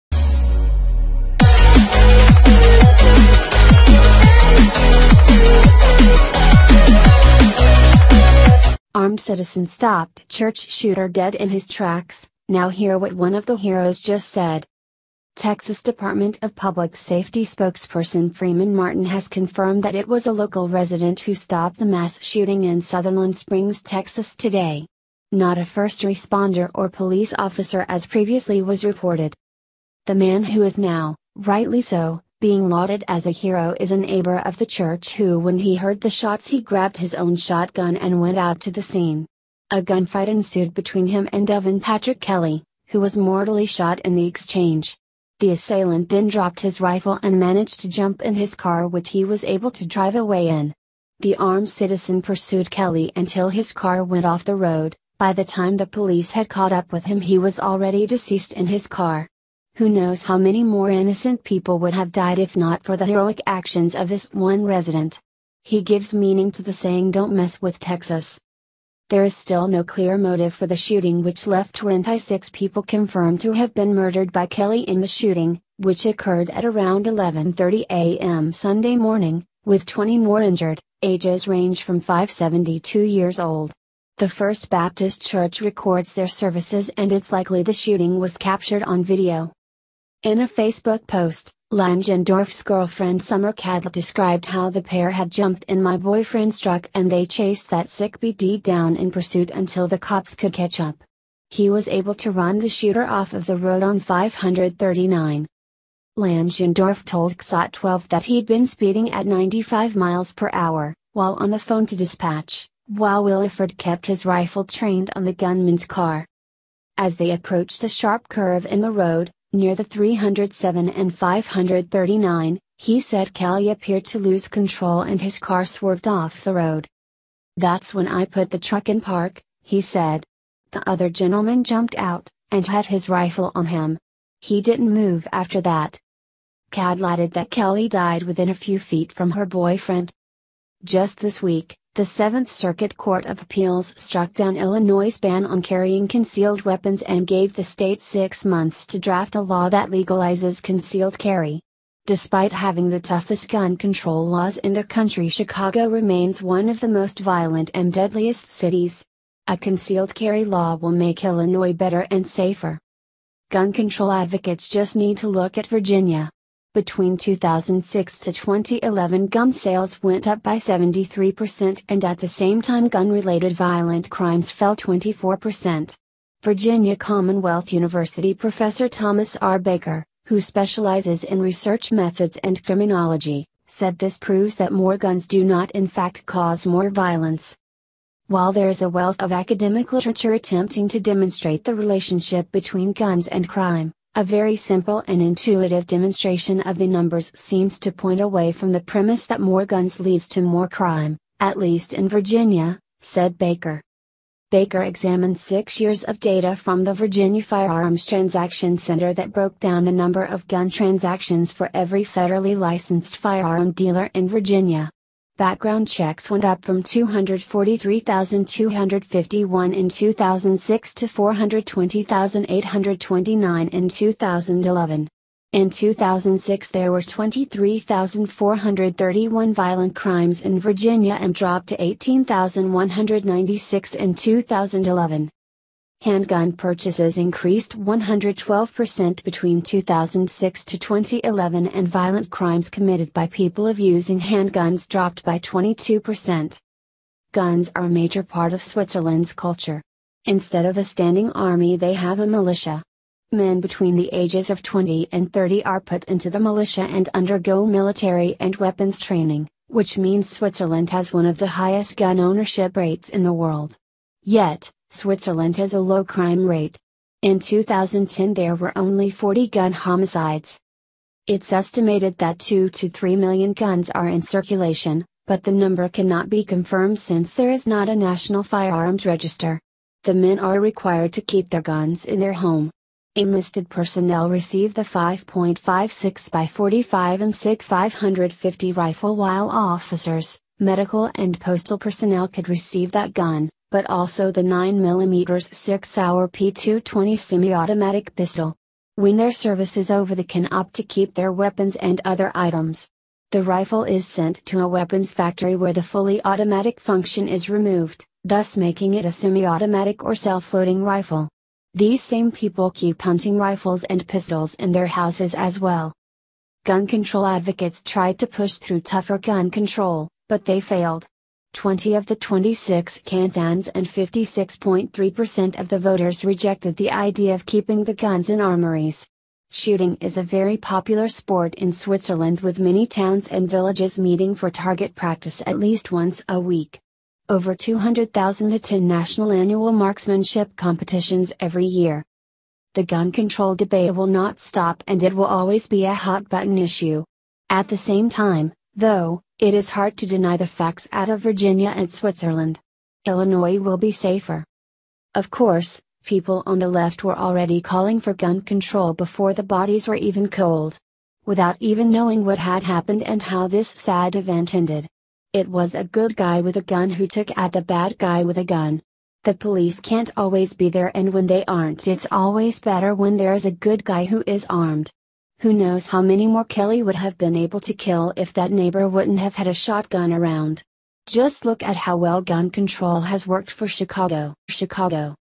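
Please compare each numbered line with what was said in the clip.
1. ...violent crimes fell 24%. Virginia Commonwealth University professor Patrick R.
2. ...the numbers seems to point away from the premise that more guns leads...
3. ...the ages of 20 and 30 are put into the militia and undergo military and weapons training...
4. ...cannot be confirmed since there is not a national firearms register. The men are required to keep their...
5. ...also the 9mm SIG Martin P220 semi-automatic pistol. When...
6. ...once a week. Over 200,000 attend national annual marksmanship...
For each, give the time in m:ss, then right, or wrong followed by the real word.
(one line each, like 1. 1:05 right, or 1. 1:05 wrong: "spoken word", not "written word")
1. 2:53 wrong: "Thomas", not "Patrick"
2. 3:16 right
3. 4:13 right
4. 4:35 right
5. 4:53 wrong: "Sauer", not "Martin"
6. 5:35 right.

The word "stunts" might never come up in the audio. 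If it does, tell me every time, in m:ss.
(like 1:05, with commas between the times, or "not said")
not said.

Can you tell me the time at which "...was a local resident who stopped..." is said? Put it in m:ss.
0:20.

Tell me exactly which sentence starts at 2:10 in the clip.
The other gentleman jumped out, and had his rifle on him.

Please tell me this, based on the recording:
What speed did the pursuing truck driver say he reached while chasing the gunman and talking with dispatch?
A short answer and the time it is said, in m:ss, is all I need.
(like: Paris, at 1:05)
95 miles per hour, at 1:49.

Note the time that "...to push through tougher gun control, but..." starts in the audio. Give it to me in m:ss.
5:18.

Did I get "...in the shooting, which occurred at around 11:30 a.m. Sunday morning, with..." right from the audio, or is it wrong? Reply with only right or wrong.
right.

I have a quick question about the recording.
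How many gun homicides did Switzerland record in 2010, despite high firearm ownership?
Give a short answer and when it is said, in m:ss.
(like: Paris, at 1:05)
40, at 4:29.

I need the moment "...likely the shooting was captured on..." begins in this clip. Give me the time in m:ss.
1:27.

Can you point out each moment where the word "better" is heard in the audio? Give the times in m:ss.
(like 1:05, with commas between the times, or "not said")
2:41, 6:12.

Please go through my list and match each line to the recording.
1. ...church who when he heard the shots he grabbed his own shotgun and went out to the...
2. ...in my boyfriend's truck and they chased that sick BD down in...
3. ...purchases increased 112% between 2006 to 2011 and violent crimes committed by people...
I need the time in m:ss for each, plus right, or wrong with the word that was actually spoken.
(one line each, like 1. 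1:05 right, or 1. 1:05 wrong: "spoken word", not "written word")
1. 0:34 right
2. 1:35 right
3. 3:56 right.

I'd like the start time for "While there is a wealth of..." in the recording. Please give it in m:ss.
3:08.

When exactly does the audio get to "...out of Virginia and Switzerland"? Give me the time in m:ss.
5:50.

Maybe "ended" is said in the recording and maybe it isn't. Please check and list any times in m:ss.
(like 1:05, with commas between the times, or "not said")
6:04.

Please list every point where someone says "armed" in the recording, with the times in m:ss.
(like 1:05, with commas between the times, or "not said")
0:08, 0:51, 6:14.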